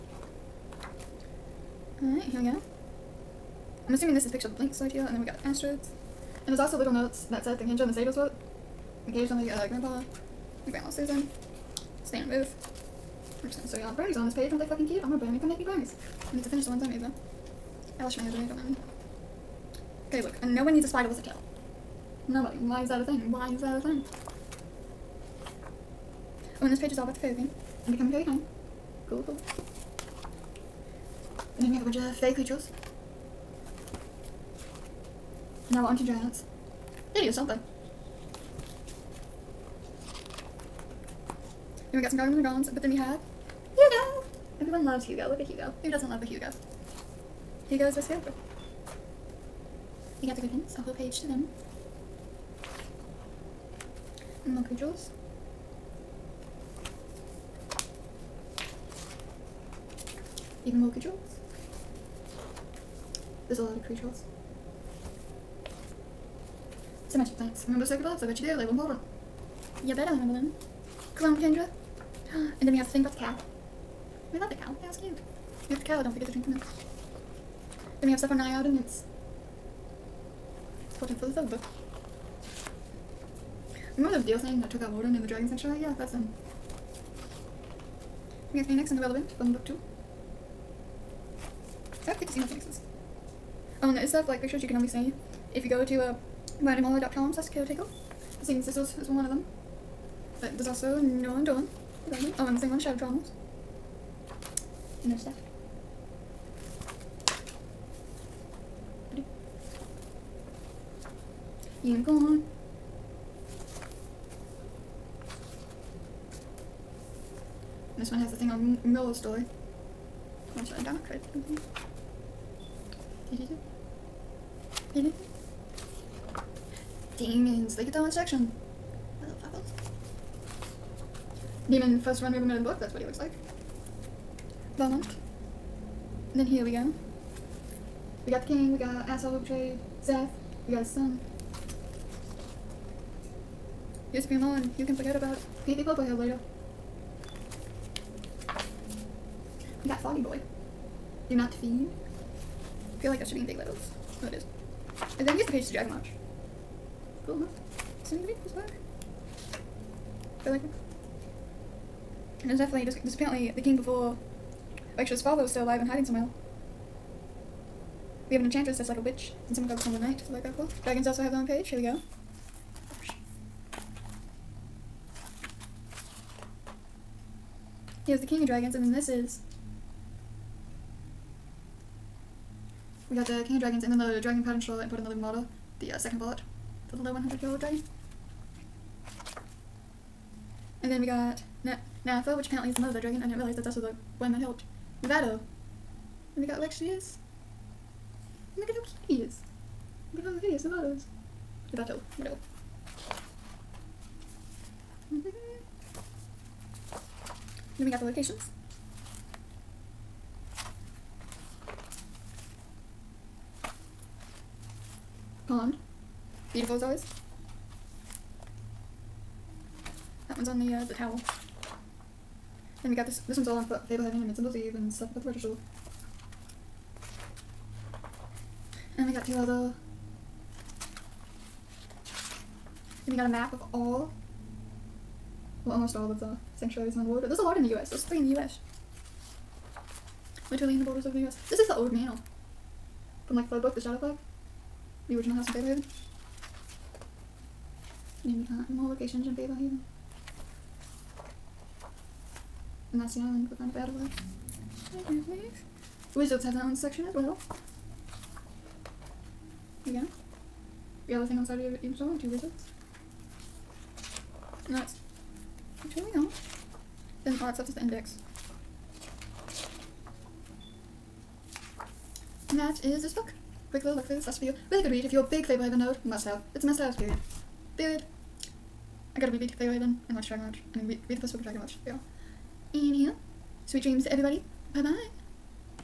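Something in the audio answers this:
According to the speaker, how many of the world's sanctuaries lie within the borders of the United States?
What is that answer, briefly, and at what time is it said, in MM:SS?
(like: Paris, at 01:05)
3, at 03:58.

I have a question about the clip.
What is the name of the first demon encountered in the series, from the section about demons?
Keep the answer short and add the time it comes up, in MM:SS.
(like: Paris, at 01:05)
Bahumat, at 02:14.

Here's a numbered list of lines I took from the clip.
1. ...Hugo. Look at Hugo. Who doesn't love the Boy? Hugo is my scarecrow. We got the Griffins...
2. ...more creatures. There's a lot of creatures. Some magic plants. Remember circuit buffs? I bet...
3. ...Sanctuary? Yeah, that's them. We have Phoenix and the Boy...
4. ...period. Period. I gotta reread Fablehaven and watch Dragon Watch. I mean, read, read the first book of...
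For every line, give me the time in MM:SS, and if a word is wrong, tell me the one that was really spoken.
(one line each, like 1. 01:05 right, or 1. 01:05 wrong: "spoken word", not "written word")
1. 00:45 wrong: "Hugo", not "Boy"
2. 01:00 right
3. 01:25 wrong: "Relevant", not "Boy"
4. 04:36 right.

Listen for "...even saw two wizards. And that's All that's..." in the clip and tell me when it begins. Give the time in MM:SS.
04:21.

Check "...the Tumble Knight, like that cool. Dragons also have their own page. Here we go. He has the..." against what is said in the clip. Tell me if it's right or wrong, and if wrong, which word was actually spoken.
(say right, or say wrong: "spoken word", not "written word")
right.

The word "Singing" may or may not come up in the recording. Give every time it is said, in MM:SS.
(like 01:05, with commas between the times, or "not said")
01:38.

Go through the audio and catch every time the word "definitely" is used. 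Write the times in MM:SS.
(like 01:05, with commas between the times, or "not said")
02:42.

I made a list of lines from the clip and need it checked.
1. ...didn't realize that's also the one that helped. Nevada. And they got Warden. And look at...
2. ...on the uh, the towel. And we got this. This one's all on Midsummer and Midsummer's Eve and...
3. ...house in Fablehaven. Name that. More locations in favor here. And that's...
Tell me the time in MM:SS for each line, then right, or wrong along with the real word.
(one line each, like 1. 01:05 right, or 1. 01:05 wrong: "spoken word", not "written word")
1. 03:13 wrong: "Lexius", not "Warden"
2. 03:40 wrong: "Fablehaven", not "Midsummer"
3. 04:05 right.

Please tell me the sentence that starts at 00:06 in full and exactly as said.
And there's also little notes that Seth and Kendra and the Sados wrote.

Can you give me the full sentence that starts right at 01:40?
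But there's also No One Doing.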